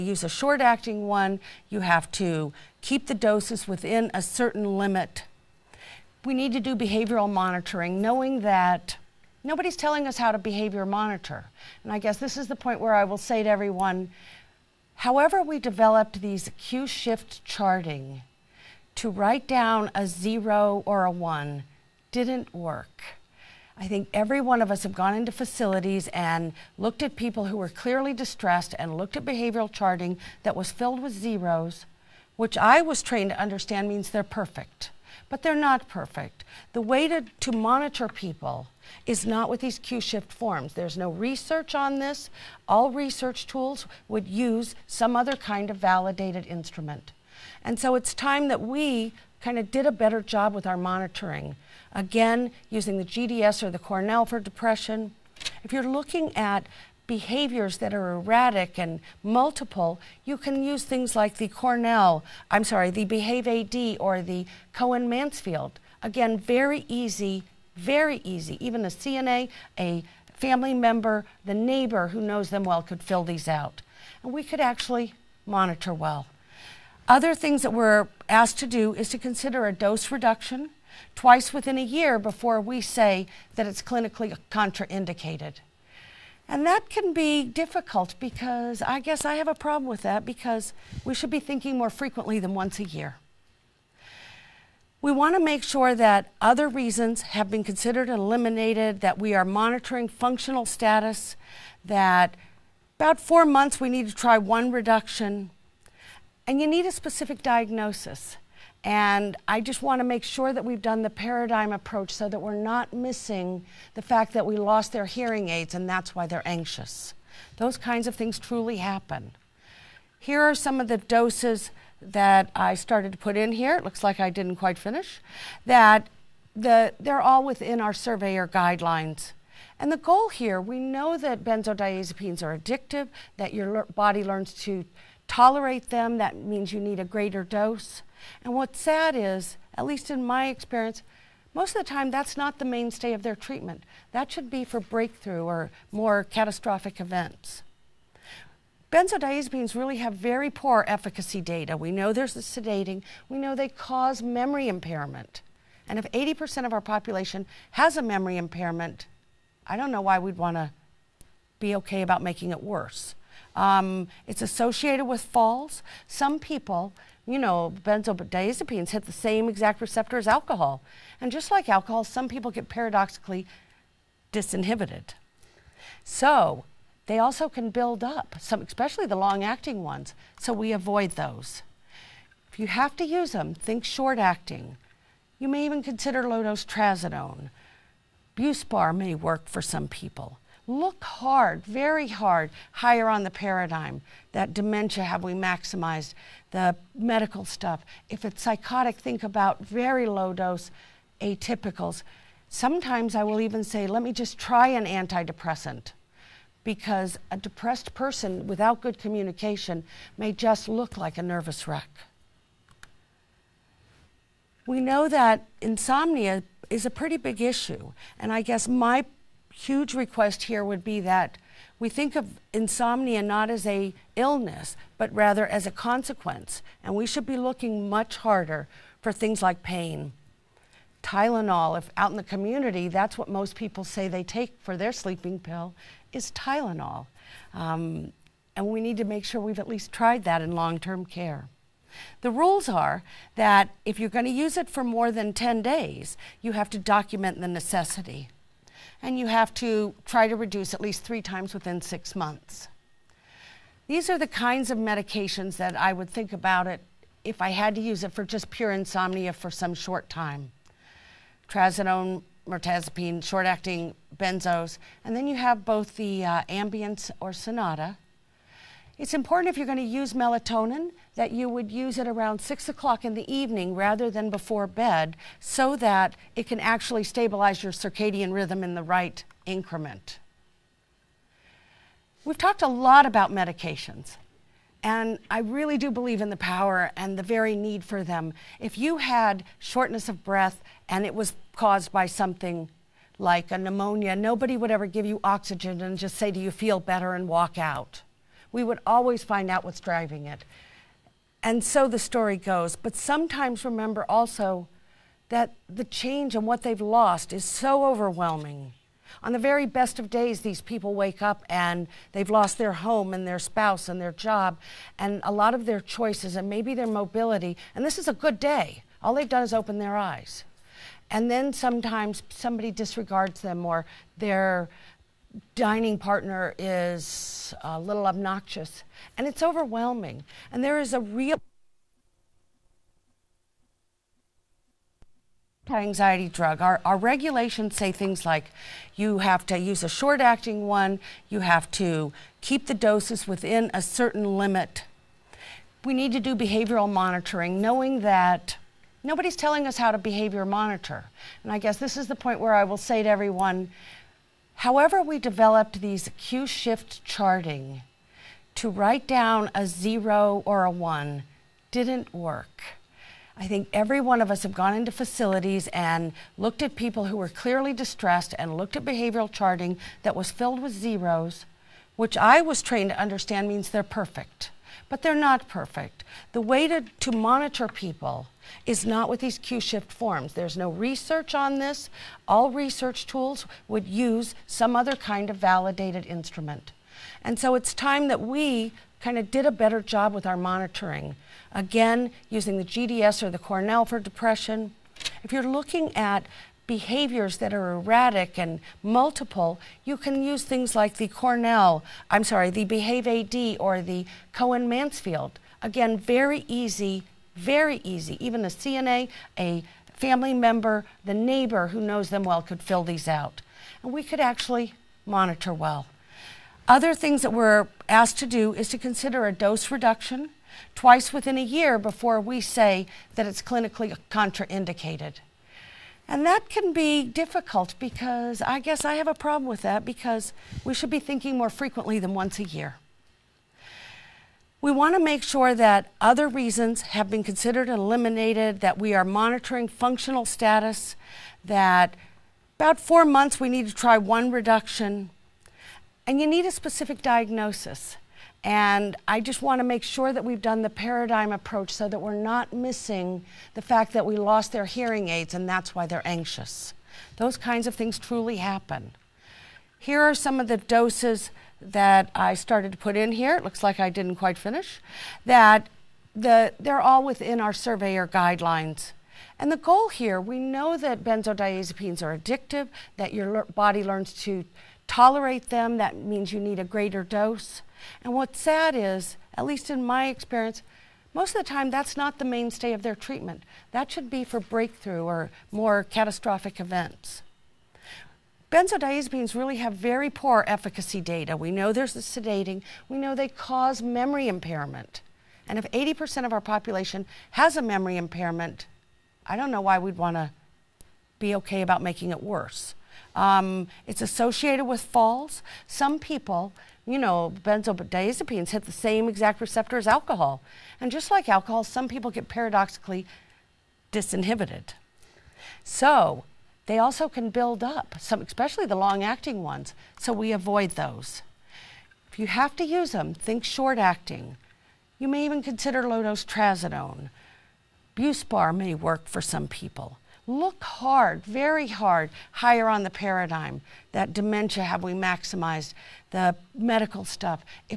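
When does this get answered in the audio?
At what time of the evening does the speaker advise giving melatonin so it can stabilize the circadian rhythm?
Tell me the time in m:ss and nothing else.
4:32.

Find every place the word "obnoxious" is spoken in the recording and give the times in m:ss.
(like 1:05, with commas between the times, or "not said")
5:28.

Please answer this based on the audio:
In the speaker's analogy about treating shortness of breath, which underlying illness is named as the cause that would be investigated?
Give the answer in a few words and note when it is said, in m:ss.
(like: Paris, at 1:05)
pneumonia, at 4:53.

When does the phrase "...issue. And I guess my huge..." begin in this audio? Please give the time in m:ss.
3:37.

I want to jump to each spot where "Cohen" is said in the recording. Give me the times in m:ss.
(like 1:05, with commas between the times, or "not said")
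1:04, 6:44.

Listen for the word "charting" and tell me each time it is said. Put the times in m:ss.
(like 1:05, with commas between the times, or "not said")
0:17, 0:29, 5:57, 6:09.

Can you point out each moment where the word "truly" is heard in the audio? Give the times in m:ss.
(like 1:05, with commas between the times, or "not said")
1:58, 7:37.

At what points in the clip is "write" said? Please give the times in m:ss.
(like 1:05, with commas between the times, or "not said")
0:19, 5:58.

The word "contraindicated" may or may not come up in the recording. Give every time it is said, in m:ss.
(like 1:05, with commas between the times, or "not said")
1:24, 7:04.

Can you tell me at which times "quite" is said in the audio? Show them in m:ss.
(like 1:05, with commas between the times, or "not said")
2:04, 7:44.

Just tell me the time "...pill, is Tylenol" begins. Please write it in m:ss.
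3:55.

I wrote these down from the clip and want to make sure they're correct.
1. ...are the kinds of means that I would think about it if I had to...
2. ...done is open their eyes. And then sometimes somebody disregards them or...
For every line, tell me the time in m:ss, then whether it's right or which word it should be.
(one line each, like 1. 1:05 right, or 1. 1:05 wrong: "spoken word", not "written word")
1. 4:14 wrong: "medications", not "means"
2. 5:19 right.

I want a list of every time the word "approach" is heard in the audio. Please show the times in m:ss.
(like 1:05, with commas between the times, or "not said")
1:51, 7:31.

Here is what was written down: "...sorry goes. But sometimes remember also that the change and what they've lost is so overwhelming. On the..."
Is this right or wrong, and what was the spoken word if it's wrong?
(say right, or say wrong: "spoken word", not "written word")
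wrong: "story", not "sorry".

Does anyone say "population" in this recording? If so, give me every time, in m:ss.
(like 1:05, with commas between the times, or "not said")
2:36, 8:16.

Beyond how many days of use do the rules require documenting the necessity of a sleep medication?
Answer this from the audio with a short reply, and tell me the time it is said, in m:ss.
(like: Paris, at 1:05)
10 days, at 4:05.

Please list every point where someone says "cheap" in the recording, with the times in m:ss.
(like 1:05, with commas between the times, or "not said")
not said.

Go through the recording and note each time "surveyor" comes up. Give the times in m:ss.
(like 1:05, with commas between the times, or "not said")
2:07, 7:47.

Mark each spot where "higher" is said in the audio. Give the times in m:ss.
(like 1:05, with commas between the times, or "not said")
3:12, 8:52.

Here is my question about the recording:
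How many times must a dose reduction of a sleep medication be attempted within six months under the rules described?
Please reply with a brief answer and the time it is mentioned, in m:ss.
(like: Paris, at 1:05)
3, at 4:11.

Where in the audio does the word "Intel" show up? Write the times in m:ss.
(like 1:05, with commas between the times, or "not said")
not said.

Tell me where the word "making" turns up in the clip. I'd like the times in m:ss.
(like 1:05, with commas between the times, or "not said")
2:42, 8:21.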